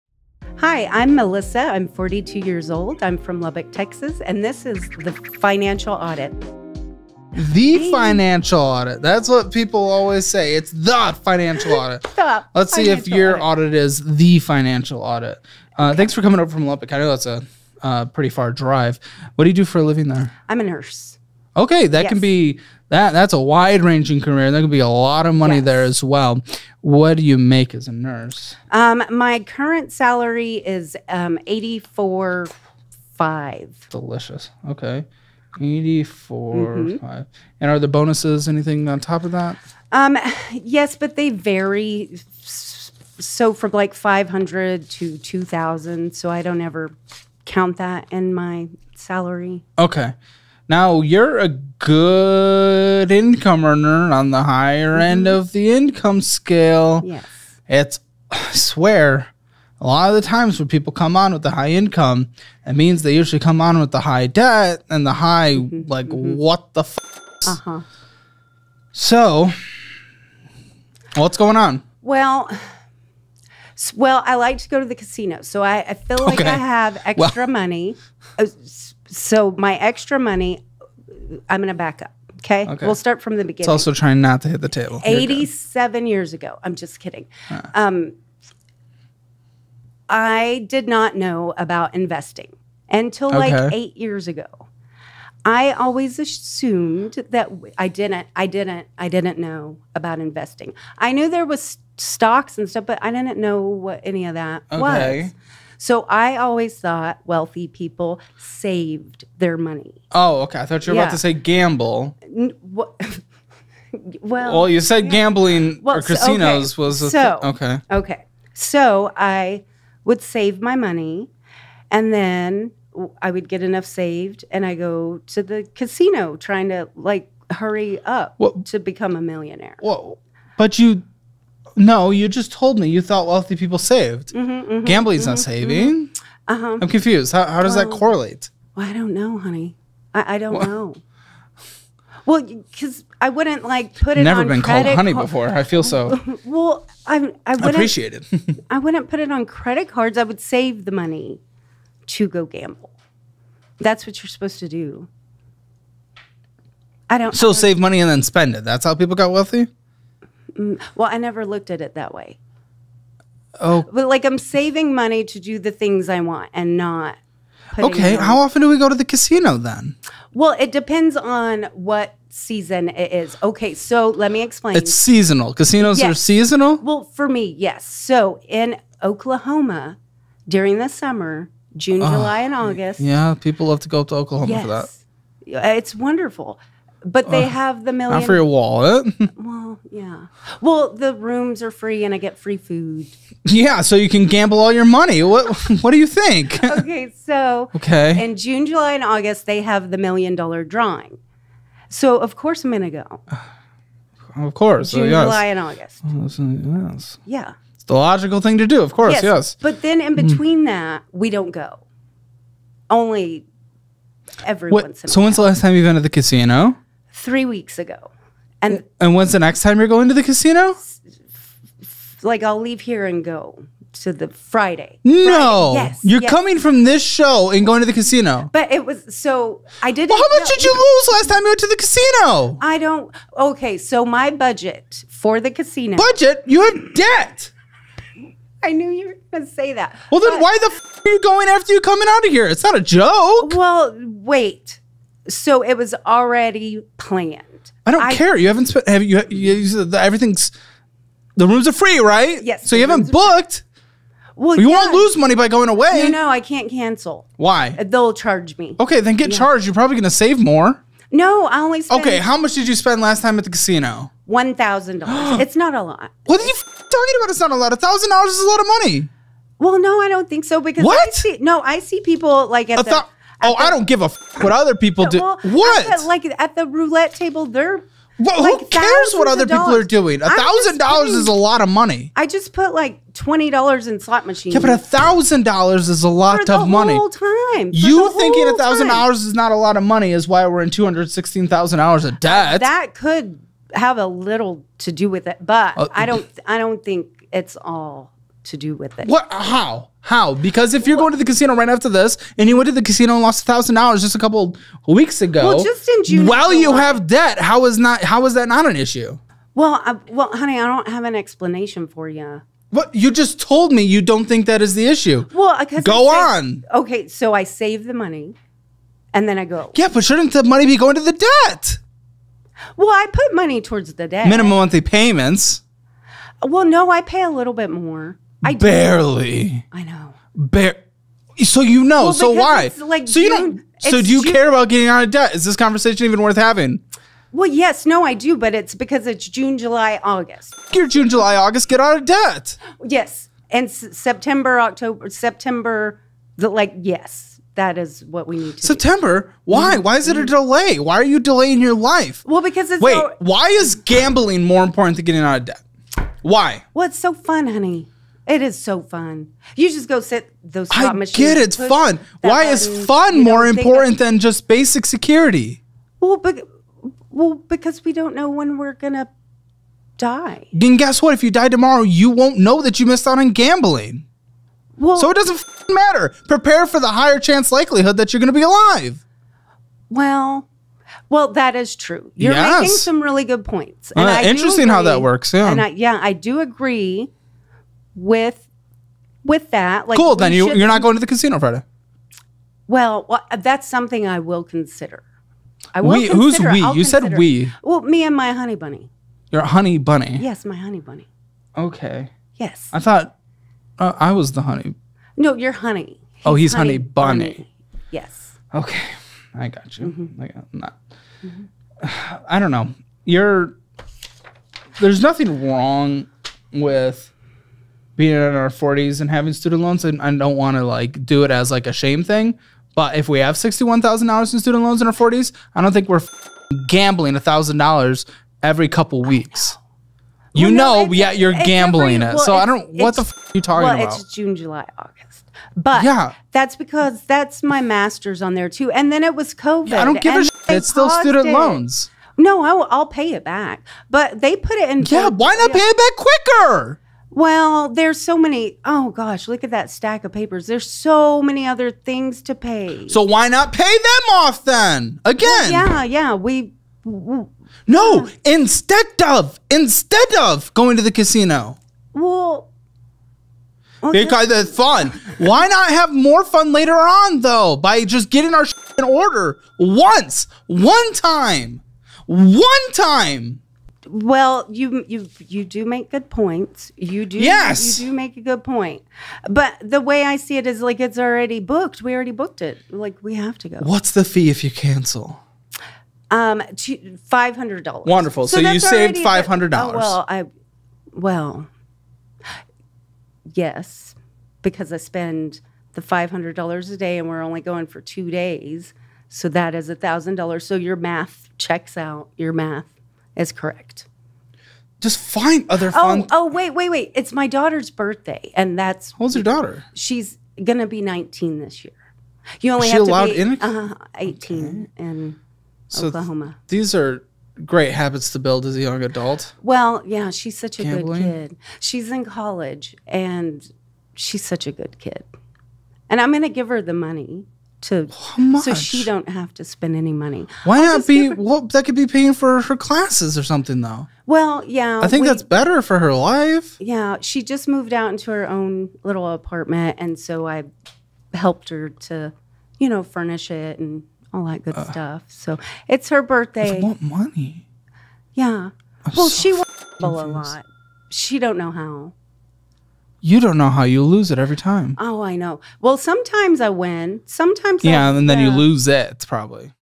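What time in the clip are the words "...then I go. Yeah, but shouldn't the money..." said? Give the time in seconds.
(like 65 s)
319 s.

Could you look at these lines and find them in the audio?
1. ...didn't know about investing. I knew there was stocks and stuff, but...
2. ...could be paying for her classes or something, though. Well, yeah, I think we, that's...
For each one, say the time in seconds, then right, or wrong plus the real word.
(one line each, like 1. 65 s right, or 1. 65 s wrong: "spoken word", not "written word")
1. 99 s right
2. 531 s right.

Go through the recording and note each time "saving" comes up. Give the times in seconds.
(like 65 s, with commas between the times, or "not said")
135 s, 164 s.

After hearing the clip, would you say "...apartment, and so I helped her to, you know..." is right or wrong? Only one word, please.
right.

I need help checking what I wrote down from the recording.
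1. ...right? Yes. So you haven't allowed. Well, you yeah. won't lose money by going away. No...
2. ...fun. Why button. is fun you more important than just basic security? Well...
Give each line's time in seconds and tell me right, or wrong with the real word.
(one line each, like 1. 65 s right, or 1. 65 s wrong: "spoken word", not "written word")
1. 251 s wrong: "booked", not "allowed"
2. 361 s right.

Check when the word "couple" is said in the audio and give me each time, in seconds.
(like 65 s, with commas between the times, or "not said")
304 s, 428 s.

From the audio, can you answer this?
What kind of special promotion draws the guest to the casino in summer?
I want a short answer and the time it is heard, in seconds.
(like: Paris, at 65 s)
Million dollar drawing, at 199 s.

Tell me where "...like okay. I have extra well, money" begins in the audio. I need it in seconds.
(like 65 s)
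76 s.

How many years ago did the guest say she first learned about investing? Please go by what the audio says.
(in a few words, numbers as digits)
8.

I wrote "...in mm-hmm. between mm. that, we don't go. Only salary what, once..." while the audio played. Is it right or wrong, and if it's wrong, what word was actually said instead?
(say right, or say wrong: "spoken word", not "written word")
wrong: "every", not "salary".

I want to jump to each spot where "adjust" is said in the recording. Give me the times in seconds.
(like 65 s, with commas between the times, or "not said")
not said.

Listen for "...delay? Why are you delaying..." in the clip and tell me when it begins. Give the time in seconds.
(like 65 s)
350 s.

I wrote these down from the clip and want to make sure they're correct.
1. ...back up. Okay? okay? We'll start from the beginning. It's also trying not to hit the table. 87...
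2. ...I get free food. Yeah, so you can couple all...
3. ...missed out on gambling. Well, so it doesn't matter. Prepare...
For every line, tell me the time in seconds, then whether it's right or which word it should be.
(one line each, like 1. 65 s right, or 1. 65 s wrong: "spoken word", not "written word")
1. 81 s right
2. 192 s wrong: "gamble", not "couple"
3. 372 s right.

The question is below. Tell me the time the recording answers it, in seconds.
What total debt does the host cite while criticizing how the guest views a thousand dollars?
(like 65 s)
290 s.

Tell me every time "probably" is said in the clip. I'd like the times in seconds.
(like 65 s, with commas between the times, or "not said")
259 s, 559 s.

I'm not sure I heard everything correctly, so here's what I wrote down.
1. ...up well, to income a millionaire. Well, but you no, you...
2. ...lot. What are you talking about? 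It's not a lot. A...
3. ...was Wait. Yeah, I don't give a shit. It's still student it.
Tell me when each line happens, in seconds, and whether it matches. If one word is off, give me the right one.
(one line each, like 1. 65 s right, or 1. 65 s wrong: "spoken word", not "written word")
1. 128 s wrong: "become", not "income"
2. 265 s right
3. 439 s wrong: "COVID", not "Wait".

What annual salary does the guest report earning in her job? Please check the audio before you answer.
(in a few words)
$84,500.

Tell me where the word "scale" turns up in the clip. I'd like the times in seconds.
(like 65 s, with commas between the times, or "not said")
56 s.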